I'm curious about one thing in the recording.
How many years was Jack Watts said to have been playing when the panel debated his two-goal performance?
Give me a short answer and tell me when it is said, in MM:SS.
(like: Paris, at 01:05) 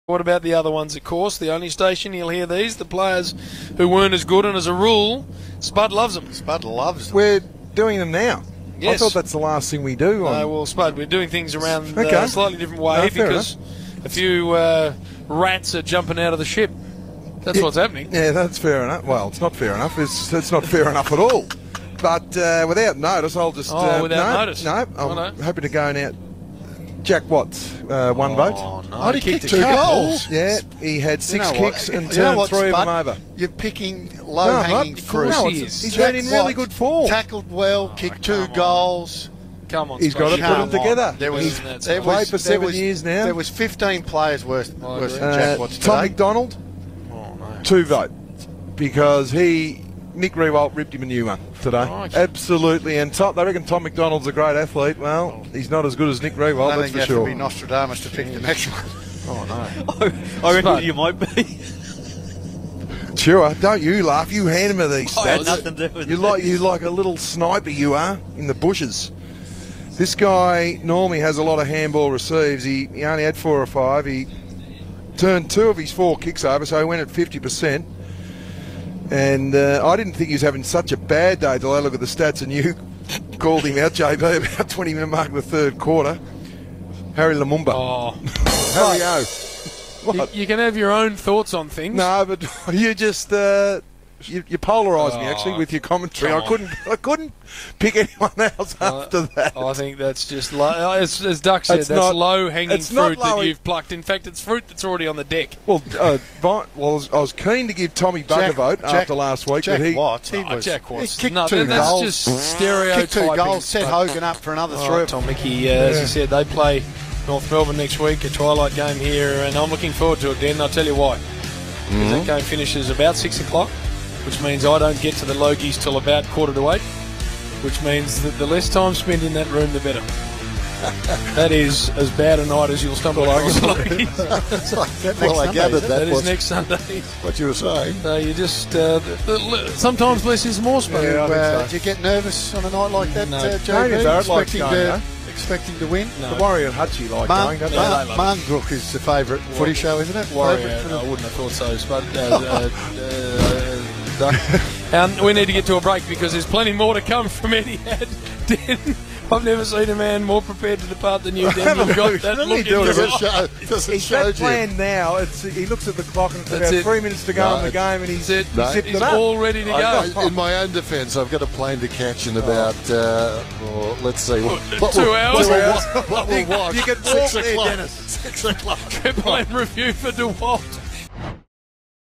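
7, at 00:42.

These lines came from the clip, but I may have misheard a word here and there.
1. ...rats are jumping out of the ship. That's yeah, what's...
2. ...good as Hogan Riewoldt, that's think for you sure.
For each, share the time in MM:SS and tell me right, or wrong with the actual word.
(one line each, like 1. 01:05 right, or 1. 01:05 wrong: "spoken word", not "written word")
1. 00:15 right
2. 00:55 wrong: "Nick", not "Hogan".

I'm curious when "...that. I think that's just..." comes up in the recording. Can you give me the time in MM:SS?
01:39.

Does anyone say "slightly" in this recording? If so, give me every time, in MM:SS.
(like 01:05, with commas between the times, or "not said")
00:12.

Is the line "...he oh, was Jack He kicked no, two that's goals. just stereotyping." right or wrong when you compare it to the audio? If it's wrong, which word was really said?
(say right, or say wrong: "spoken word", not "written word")
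right.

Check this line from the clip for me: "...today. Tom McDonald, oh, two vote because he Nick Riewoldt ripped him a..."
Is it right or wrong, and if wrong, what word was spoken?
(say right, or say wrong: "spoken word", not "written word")
right.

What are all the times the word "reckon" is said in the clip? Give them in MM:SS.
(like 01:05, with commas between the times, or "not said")
00:53, 01:00.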